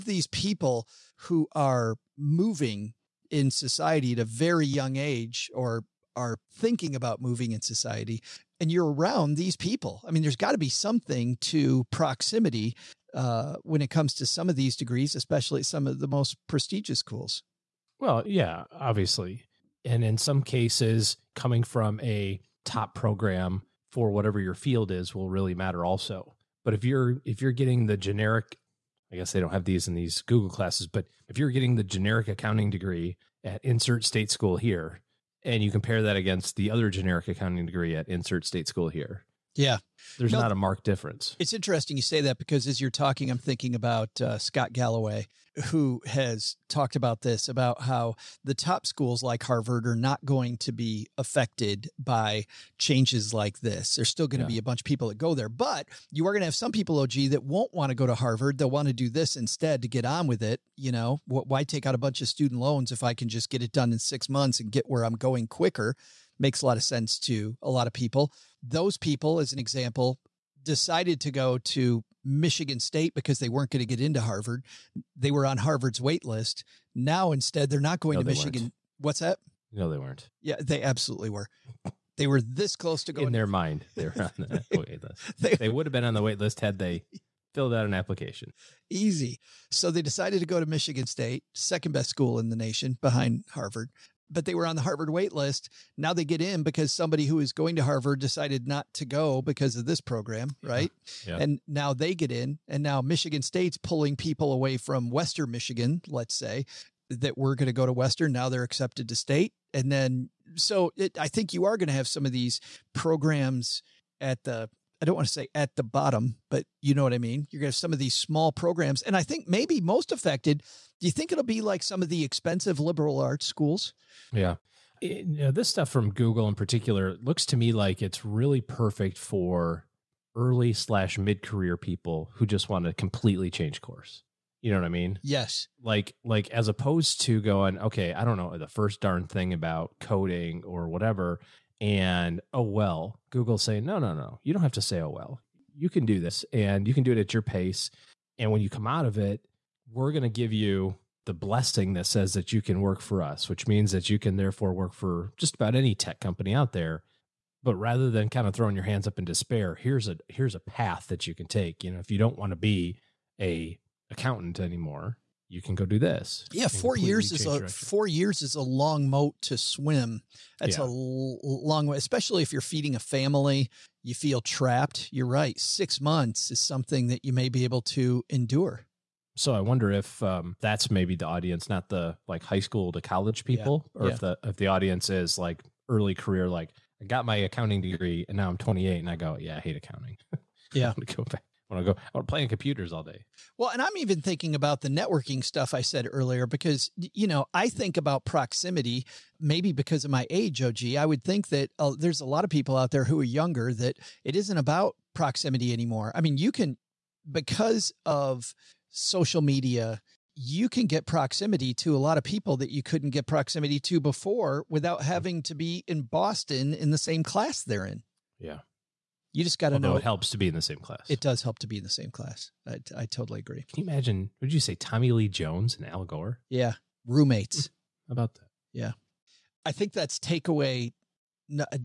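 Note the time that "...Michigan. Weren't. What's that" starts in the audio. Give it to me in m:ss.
1:18.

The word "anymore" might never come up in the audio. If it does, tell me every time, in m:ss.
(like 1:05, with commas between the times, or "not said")
2:44, 3:25.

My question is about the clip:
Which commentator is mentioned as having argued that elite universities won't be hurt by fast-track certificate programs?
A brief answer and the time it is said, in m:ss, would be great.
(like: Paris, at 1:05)
Scott Galloway, at 0:44.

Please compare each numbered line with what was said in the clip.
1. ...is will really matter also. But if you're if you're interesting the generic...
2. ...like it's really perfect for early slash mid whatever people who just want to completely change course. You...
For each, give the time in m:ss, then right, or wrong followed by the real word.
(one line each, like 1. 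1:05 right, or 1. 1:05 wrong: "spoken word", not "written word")
1. 0:24 wrong: "getting", not "interesting"
2. 2:07 wrong: "career", not "whatever".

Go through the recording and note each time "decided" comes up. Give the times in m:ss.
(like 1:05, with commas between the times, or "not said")
1:10, 1:30, 1:38.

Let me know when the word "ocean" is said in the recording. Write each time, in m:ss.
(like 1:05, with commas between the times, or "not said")
not said.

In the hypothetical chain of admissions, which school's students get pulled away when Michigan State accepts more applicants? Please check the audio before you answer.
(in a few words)
Western Michigan.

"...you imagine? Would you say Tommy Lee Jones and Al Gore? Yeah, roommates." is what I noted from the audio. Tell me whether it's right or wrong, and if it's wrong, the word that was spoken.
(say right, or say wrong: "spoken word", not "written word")
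right.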